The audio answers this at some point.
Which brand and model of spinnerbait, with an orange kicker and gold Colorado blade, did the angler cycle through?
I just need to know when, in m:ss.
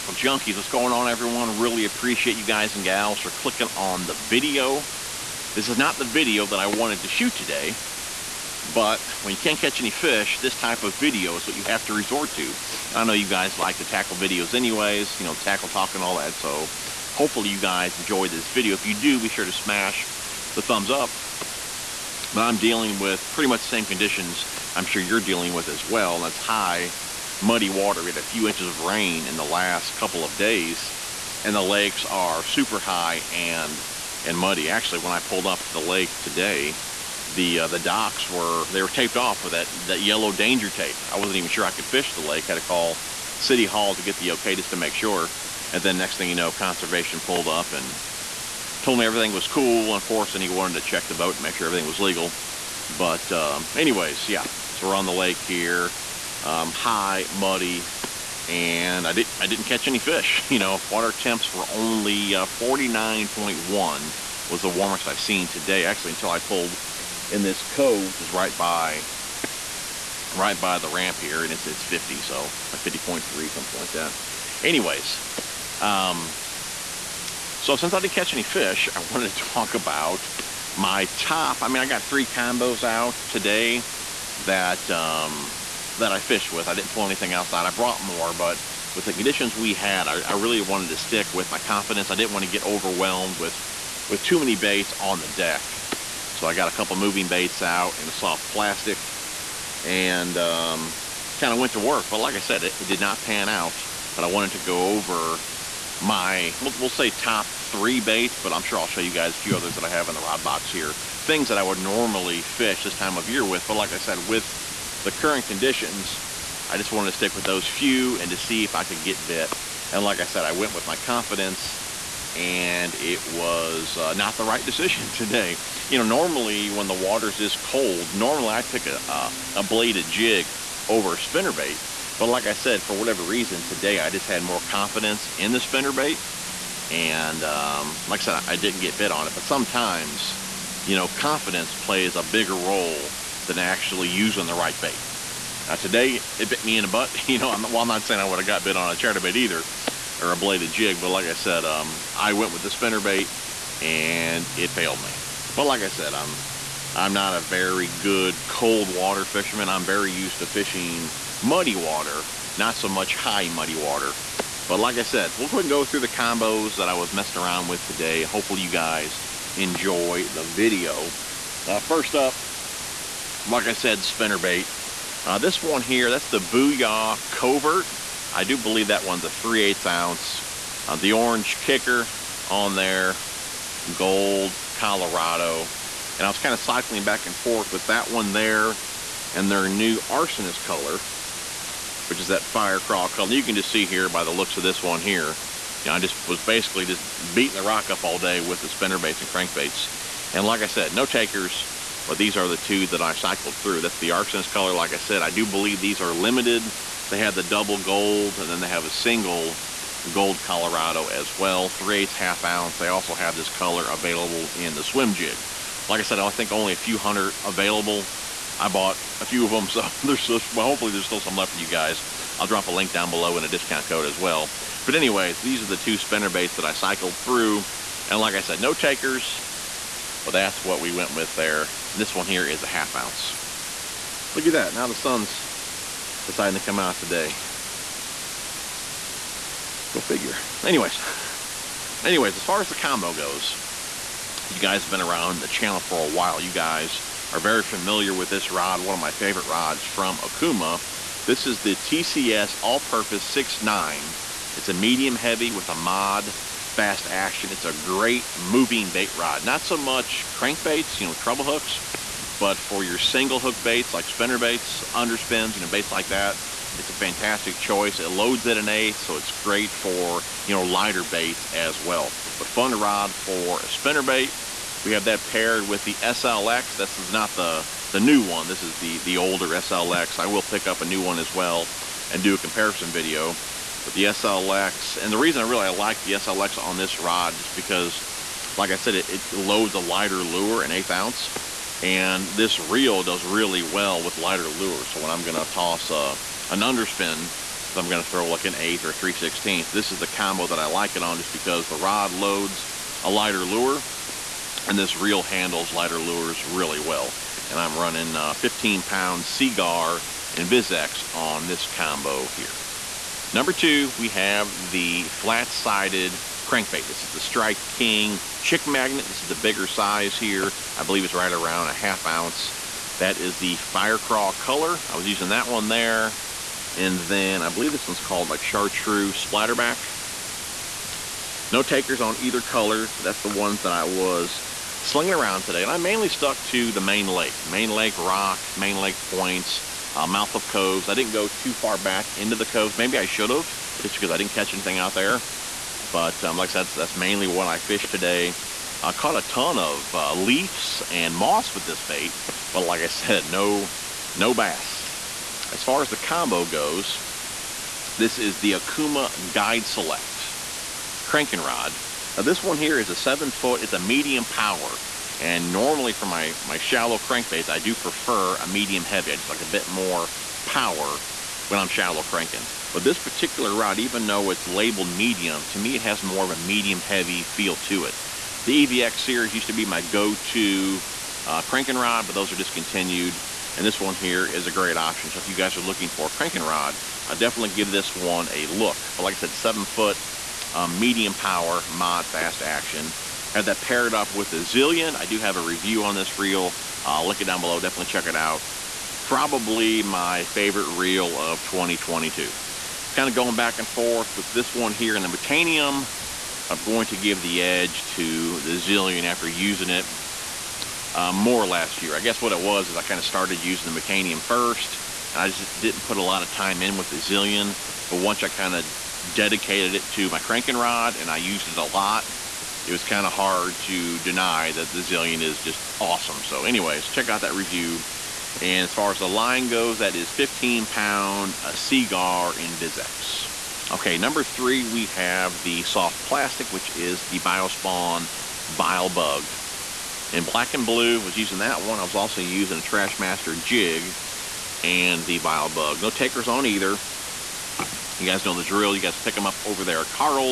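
2:56.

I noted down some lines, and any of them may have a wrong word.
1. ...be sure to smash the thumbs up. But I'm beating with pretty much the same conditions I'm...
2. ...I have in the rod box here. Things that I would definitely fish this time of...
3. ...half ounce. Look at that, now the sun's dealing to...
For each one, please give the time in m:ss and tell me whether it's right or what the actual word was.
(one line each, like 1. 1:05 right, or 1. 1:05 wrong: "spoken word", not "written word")
1. 0:19 wrong: "dealing", not "beating"
2. 1:49 wrong: "normally", not "definitely"
3. 3:52 wrong: "deciding", not "dealing".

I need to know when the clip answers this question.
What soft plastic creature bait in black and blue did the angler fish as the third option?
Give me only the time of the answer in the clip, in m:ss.
7:17.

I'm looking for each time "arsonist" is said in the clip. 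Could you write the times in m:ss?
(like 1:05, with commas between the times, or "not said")
3:10.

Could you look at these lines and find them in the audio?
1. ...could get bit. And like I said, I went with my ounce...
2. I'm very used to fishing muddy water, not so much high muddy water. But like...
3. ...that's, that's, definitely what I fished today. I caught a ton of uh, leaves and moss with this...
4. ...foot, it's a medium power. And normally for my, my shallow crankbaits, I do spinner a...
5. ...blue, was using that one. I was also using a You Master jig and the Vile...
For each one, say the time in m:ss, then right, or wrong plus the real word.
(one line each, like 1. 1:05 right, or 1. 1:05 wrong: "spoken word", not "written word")
1. 1:58 wrong: "confidence", not "ounce"
2. 2:39 right
3. 5:46 wrong: "mainly", not "definitely"
4. 6:03 wrong: "prefer", not "spinner"
5. 7:20 wrong: "Trash", not "You".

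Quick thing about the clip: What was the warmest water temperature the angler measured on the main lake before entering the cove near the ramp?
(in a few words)
49.1.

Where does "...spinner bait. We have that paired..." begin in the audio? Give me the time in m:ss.
4:33.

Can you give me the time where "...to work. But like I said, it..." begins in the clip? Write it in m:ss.
1:41.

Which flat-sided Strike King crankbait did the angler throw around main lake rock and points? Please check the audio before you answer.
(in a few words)
Chick Magnet.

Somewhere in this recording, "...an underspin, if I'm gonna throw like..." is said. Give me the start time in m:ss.
4:56.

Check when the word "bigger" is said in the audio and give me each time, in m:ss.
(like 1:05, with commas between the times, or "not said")
2:22, 5:19.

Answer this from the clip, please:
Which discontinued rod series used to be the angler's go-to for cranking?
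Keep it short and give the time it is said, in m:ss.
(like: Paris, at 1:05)
EVX, at 6:18.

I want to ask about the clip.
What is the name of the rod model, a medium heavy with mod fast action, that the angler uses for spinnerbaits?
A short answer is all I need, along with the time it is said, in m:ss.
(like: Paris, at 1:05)
TCS All-Purpose 6.9, at 4:11.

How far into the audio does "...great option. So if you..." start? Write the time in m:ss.
6:24.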